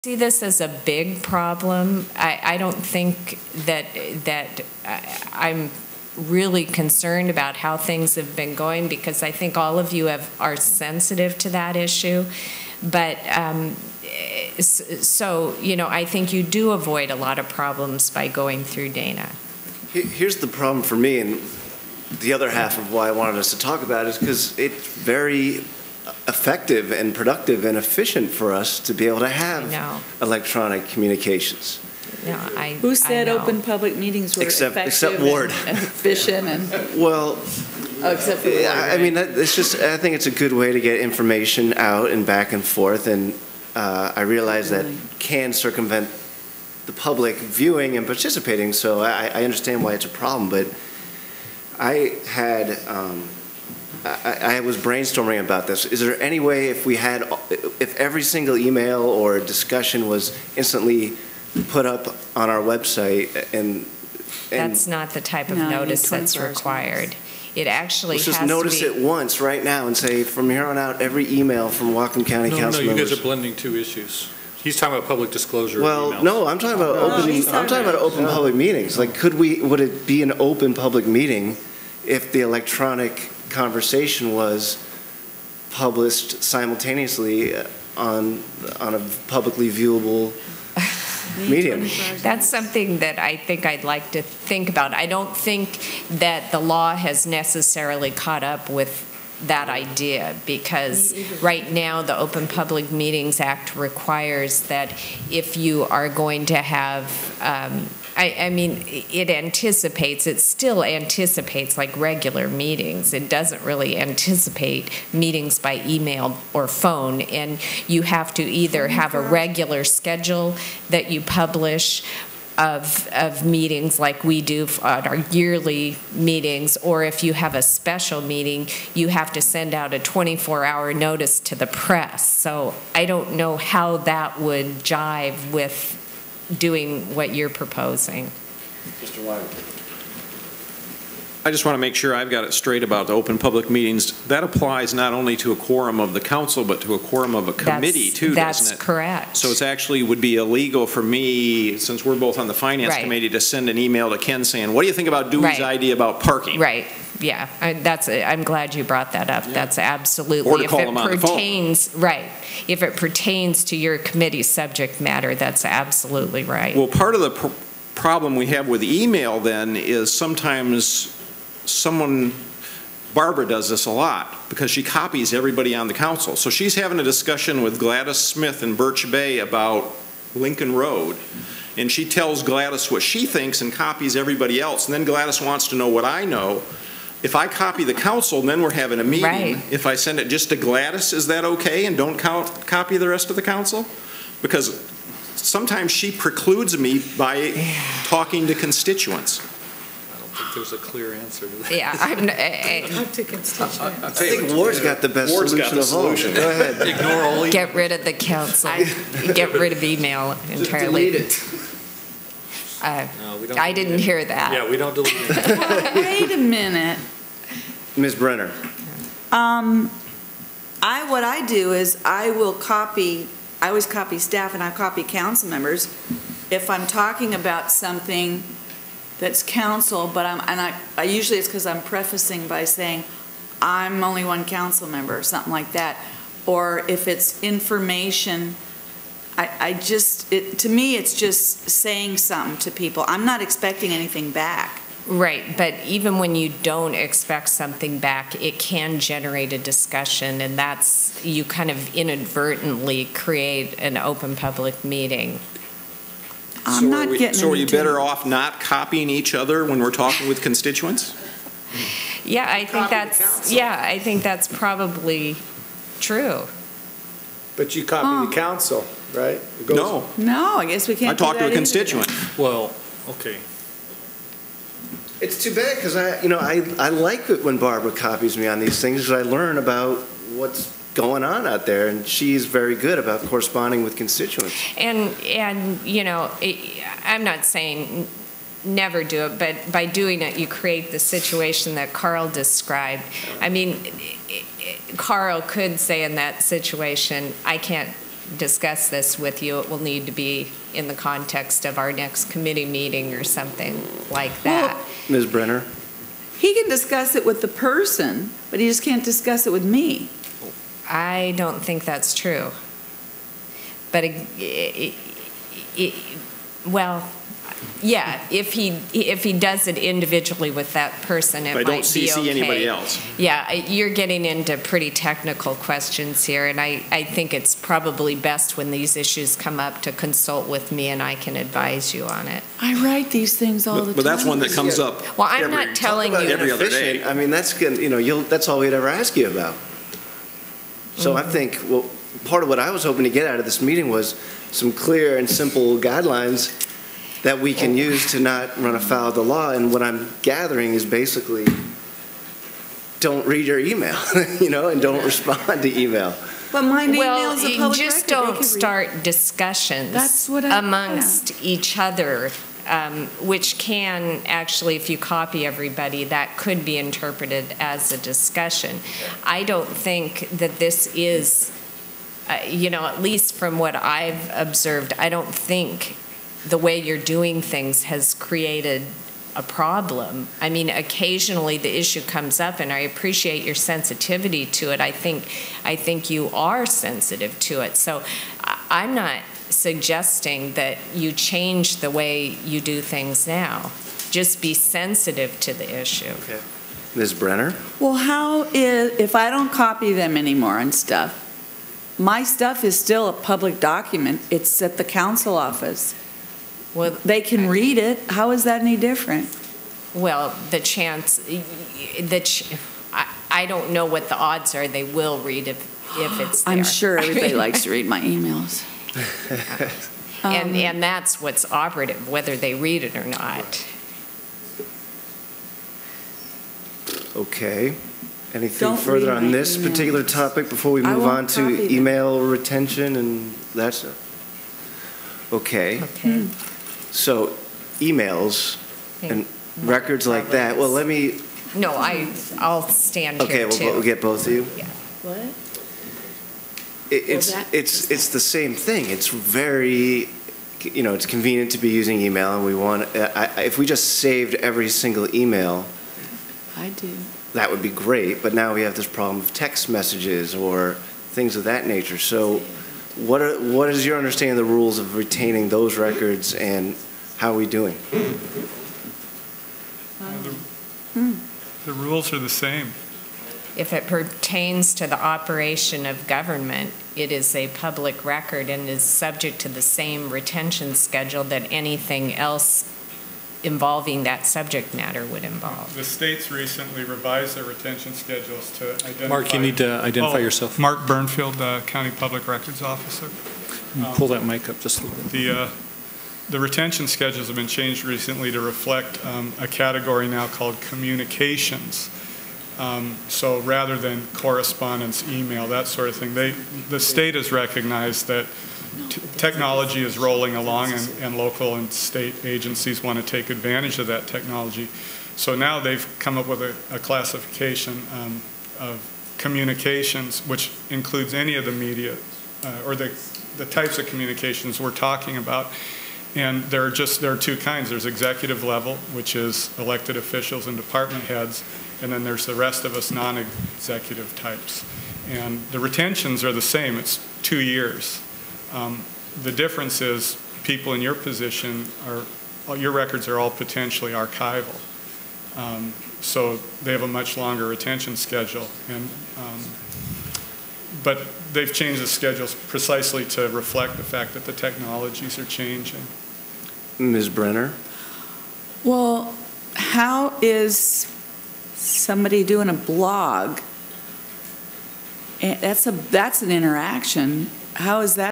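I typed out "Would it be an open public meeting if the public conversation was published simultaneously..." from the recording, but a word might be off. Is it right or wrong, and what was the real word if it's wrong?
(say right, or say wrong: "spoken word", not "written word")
wrong: "electronic", not "public".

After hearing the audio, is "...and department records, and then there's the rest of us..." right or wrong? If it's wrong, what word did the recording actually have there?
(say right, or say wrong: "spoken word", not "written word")
wrong: "heads", not "records".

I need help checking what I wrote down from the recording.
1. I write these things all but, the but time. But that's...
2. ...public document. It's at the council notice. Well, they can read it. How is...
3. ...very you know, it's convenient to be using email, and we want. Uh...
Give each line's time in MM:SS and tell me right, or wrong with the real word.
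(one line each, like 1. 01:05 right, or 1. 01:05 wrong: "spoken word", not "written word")
1. 05:32 right
2. 06:43 wrong: "office", not "notice"
3. 07:29 right.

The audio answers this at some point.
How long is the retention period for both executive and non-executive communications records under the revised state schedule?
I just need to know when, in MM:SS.
08:57.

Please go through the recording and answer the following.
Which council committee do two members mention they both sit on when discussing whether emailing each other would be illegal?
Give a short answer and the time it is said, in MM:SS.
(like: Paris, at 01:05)
finance, at 02:32.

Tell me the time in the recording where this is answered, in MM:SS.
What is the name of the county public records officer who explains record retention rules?
08:10.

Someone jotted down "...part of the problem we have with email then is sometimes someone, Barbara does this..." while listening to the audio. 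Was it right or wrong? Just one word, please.
right.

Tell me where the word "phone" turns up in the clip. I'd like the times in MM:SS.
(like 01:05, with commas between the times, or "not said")
01:56, 02:41.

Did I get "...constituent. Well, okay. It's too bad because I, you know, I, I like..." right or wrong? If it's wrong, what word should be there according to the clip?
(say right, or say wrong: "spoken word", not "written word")
right.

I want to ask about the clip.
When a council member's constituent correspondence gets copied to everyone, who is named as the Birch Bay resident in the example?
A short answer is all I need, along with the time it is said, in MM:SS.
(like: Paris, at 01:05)
Gladys Smith, at 02:57.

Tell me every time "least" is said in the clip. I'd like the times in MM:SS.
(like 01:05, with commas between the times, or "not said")
06:13.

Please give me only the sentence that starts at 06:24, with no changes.
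I think, I think you are sensitive to it.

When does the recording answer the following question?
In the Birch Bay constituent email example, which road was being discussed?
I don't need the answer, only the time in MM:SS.
03:00.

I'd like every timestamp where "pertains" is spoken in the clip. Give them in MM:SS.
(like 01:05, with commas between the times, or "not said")
02:42, 07:53.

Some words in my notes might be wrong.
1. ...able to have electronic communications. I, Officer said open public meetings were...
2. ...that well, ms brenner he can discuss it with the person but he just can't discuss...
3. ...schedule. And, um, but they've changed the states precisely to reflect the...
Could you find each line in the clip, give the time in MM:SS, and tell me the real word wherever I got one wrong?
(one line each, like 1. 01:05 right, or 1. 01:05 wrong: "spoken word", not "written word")
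1. 00:29 wrong: "Who", not "Officer"
2. 05:04 right
3. 09:07 wrong: "schedules", not "states".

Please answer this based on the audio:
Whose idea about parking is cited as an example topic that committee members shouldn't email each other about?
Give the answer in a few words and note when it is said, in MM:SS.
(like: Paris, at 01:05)
Dewey, at 02:35.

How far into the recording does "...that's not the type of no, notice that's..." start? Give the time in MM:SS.
01:04.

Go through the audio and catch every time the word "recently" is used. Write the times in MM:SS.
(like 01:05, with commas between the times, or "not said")
08:06, 08:17.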